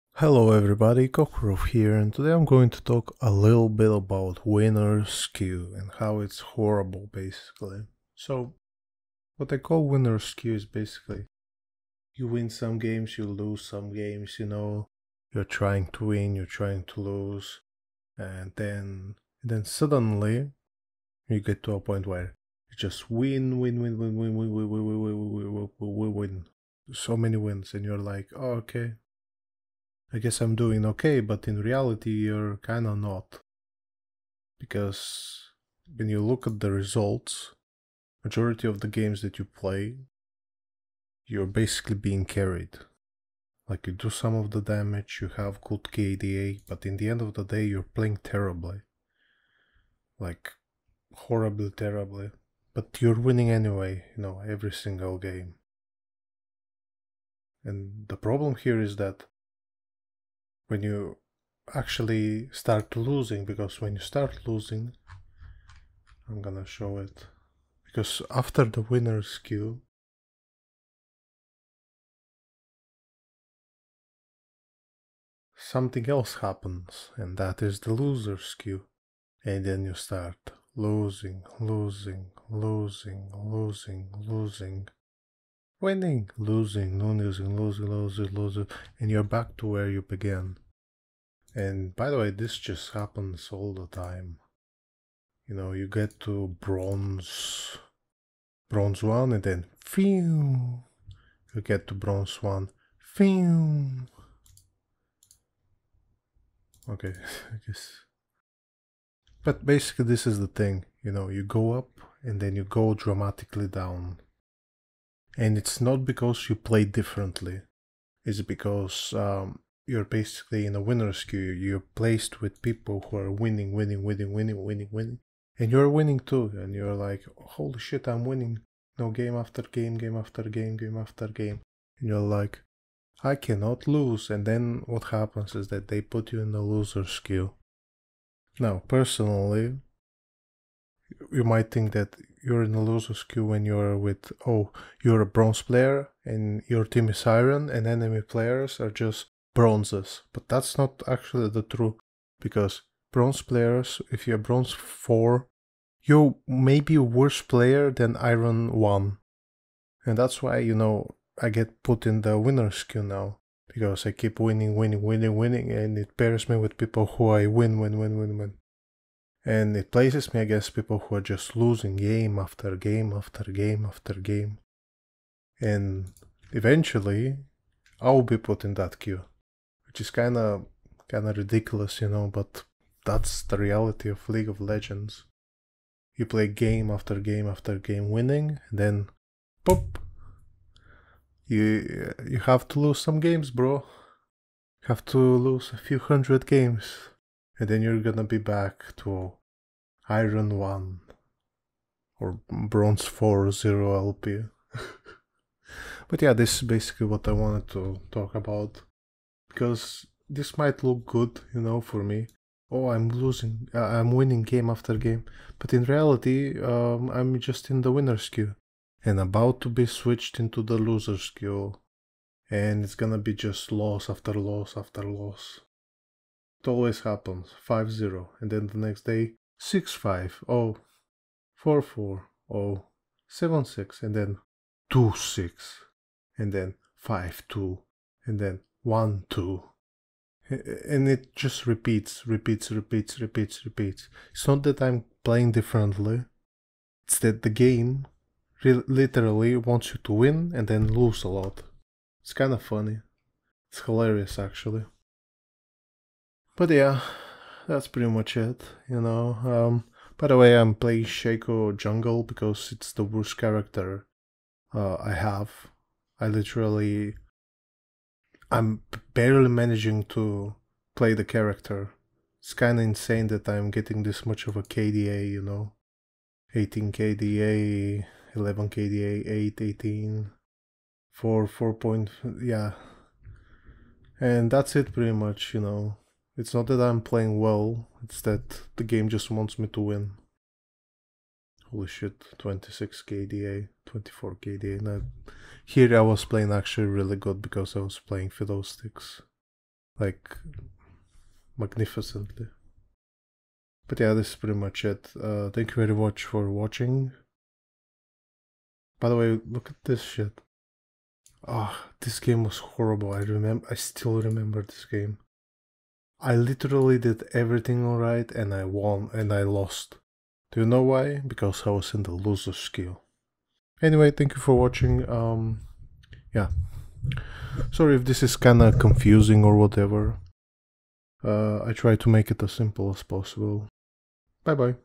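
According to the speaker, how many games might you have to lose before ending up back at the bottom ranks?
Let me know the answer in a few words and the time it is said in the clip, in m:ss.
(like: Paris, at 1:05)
a few hundred, at 3:15.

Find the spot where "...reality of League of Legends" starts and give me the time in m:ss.
3:03.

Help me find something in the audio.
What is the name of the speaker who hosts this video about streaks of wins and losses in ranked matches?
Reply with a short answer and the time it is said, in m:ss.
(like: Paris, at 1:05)
Kokorov, at 0:01.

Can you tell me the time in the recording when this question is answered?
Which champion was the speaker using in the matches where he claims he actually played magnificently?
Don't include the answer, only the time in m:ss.
4:58.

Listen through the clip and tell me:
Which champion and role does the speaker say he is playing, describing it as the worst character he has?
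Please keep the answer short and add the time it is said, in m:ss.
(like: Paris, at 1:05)
Shaco Jungle, at 4:21.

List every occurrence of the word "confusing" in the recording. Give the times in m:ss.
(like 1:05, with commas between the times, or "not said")
5:28.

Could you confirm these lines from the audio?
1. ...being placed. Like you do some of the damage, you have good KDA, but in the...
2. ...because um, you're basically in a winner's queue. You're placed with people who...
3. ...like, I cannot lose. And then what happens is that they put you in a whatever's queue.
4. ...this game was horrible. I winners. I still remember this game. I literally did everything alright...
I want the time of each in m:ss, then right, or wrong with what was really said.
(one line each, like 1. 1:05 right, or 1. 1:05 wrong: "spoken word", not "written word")
1. 0:41 wrong: "carried", not "placed"
2. 1:58 right
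3. 2:12 wrong: "loser", not "whatever"
4. 5:11 wrong: "remember", not "winners".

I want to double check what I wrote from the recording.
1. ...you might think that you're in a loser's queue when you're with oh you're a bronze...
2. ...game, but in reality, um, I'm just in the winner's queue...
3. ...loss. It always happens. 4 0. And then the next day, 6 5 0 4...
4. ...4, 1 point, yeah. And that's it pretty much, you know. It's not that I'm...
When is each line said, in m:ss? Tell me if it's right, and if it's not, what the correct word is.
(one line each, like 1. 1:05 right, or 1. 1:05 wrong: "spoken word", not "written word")
1. 2:21 right
2. 3:34 right
3. 3:45 wrong: "5", not "4"
4. 4:41 wrong: "4", not "1".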